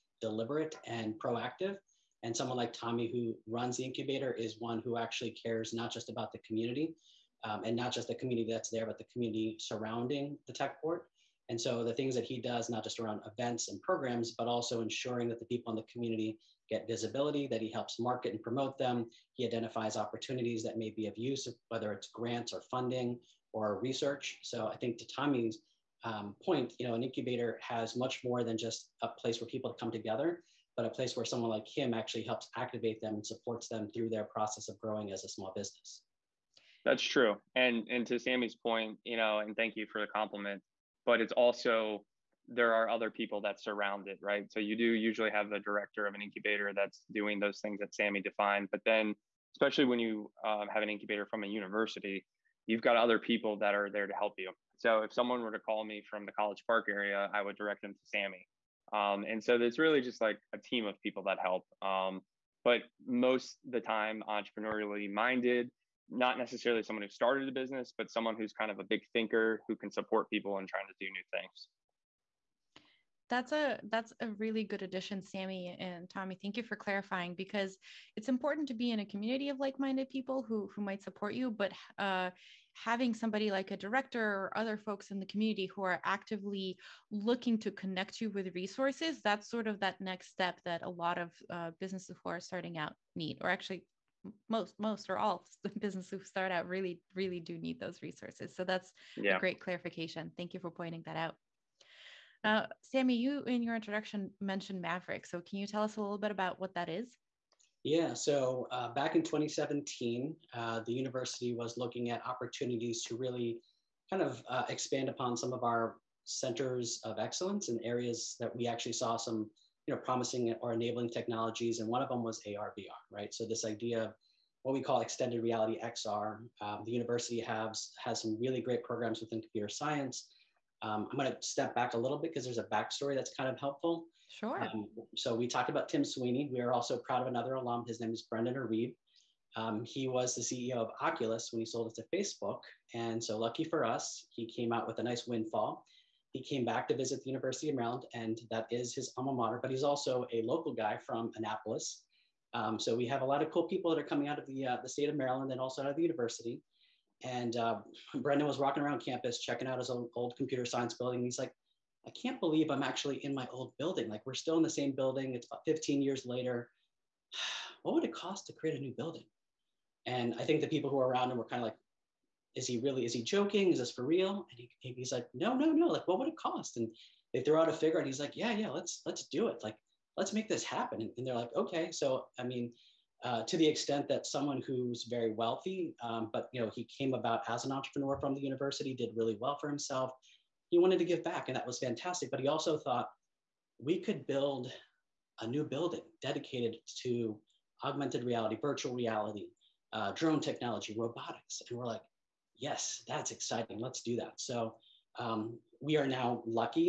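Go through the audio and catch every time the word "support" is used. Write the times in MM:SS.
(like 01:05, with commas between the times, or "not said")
00:33, 01:09, 01:21.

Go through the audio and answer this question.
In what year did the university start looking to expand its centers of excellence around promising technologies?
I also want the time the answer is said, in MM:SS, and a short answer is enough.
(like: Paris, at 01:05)
2017, at 01:49.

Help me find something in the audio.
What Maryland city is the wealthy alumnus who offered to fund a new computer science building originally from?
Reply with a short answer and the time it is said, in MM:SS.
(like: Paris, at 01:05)
Annapolis, at 02:31.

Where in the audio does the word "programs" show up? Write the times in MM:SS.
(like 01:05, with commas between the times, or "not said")
00:13, 02:08.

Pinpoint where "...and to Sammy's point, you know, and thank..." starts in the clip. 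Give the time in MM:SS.
00:37.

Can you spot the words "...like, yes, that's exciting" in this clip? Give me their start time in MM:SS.
03:21.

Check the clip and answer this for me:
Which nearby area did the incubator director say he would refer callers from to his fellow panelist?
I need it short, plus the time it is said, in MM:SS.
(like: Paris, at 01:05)
College Park, at 00:56.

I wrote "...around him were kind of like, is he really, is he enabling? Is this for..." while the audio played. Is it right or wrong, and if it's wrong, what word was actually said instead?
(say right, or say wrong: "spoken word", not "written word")
wrong: "joking", not "enabling".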